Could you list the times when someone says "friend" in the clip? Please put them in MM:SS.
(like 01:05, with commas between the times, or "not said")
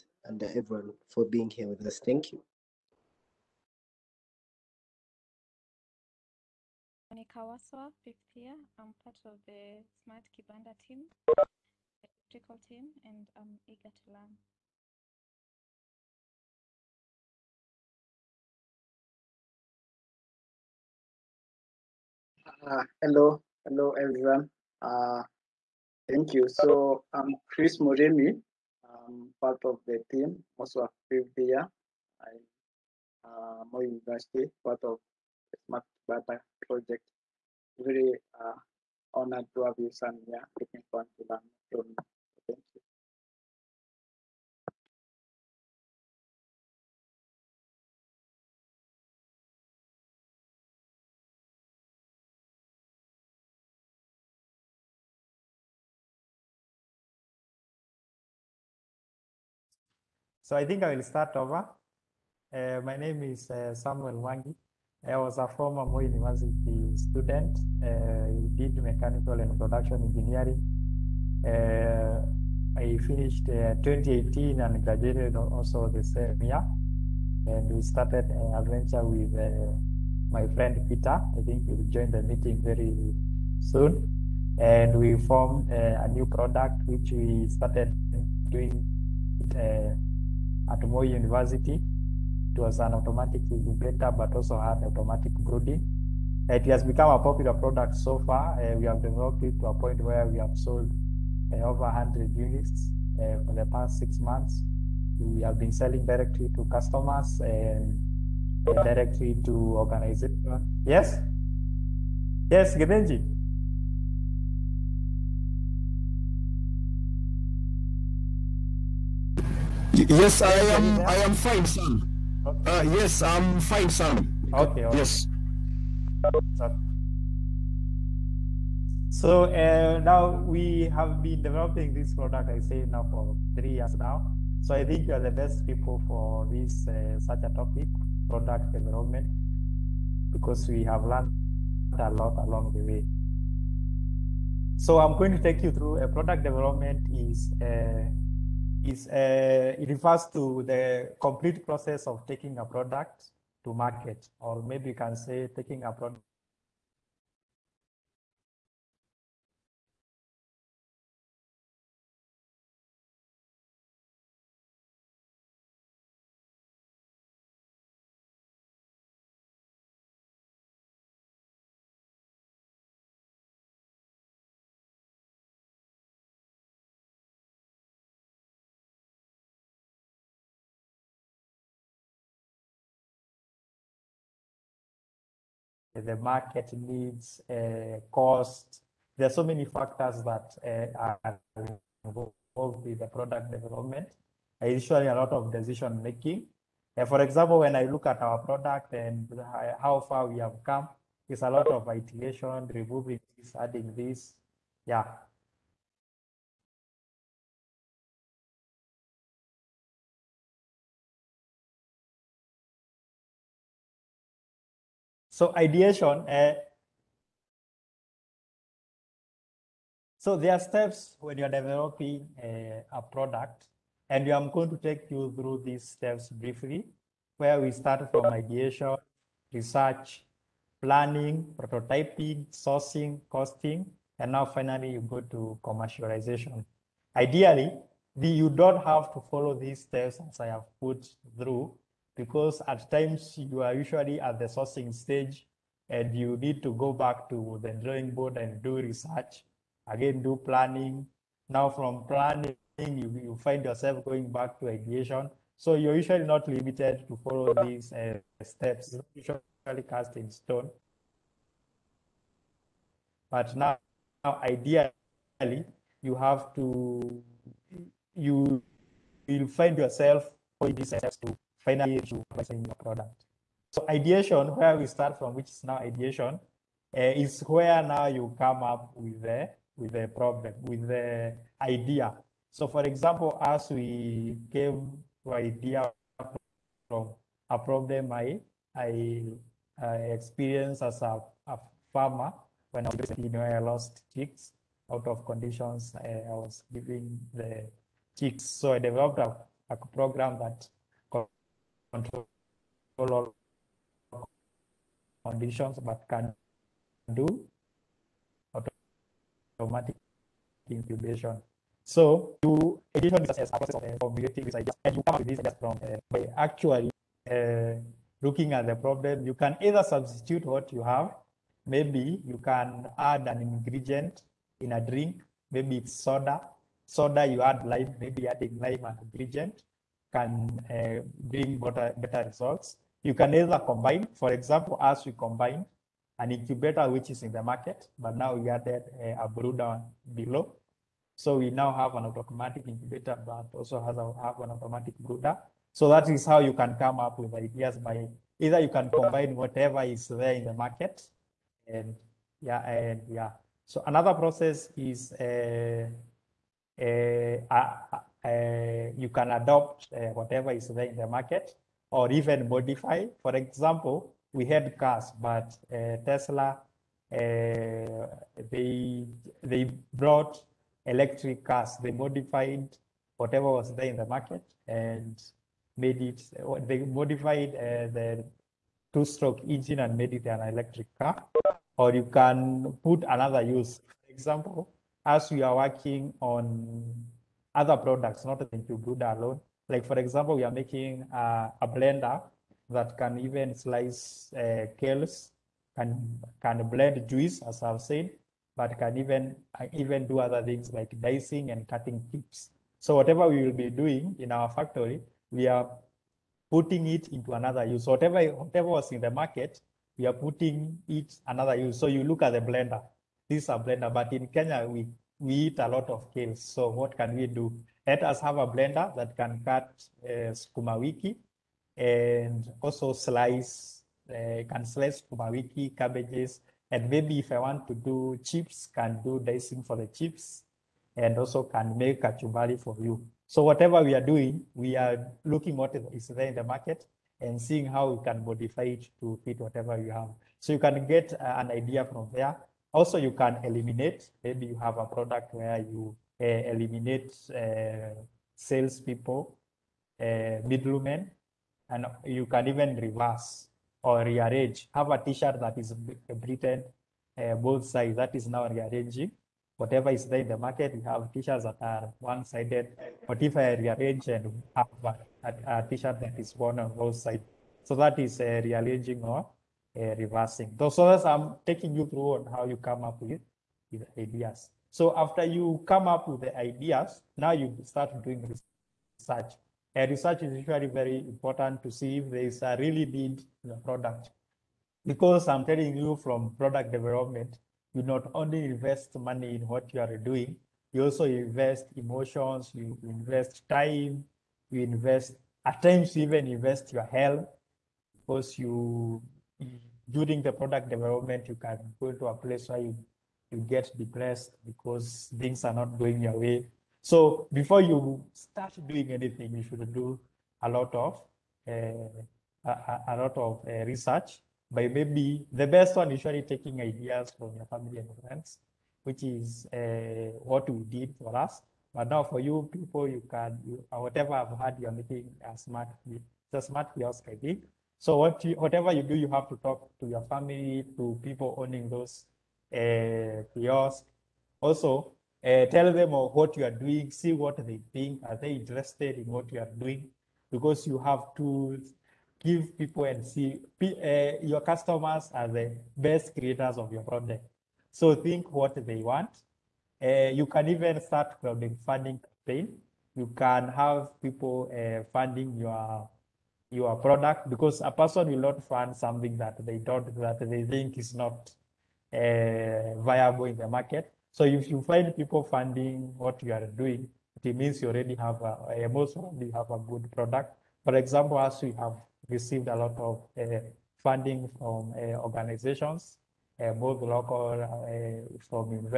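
01:20, 08:38.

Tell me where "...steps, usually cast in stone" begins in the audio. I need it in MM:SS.
04:18.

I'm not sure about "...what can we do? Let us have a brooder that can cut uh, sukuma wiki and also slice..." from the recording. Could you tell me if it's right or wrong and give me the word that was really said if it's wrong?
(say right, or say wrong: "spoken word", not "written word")
wrong: "blender", not "brooder".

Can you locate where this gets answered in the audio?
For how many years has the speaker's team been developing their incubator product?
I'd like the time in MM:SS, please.
02:13.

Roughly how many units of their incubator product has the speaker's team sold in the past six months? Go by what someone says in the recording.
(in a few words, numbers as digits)
Over 100.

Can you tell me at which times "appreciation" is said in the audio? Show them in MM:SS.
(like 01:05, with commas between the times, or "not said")
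not said.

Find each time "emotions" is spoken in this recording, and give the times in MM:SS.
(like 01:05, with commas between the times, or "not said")
08:11.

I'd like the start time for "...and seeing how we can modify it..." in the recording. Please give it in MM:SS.
07:17.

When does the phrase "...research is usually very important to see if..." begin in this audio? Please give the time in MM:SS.
07:59.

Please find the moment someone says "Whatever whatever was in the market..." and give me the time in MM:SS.
06:47.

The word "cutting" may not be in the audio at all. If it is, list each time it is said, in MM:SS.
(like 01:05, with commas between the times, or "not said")
06:41.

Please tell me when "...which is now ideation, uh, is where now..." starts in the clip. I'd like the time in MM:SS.
04:35.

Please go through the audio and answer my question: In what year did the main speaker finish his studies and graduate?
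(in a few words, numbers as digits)
2018.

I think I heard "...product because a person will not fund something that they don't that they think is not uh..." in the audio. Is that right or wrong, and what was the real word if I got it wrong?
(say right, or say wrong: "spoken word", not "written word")
right.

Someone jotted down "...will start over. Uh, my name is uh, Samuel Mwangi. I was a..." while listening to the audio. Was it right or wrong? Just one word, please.
right.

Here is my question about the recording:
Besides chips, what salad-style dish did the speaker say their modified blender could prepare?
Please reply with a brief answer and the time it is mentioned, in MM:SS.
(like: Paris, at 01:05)
Kachumbari, at 07:12.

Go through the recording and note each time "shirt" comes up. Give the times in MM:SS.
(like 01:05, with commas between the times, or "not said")
07:34, 07:41, 07:45.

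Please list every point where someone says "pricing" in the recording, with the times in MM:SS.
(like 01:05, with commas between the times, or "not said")
04:32.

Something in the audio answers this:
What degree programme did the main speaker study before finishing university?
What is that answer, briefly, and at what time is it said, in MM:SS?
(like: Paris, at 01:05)
Mechanical and production engineering, at 01:08.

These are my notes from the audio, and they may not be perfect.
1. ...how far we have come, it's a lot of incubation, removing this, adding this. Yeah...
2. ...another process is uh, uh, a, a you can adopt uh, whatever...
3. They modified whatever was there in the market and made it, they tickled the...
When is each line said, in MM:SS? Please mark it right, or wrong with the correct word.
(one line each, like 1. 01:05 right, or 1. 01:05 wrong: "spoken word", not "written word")
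1. 03:19 wrong: "iteration", not "incubation"
2. 05:53 right
3. 06:11 wrong: "modified", not "tickled".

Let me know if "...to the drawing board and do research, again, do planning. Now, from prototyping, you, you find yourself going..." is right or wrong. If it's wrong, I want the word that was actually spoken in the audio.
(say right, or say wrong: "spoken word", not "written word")
wrong: "planning", not "prototyping".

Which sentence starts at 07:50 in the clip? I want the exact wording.
So that's I'm taking you through on how you come up with, with ideas.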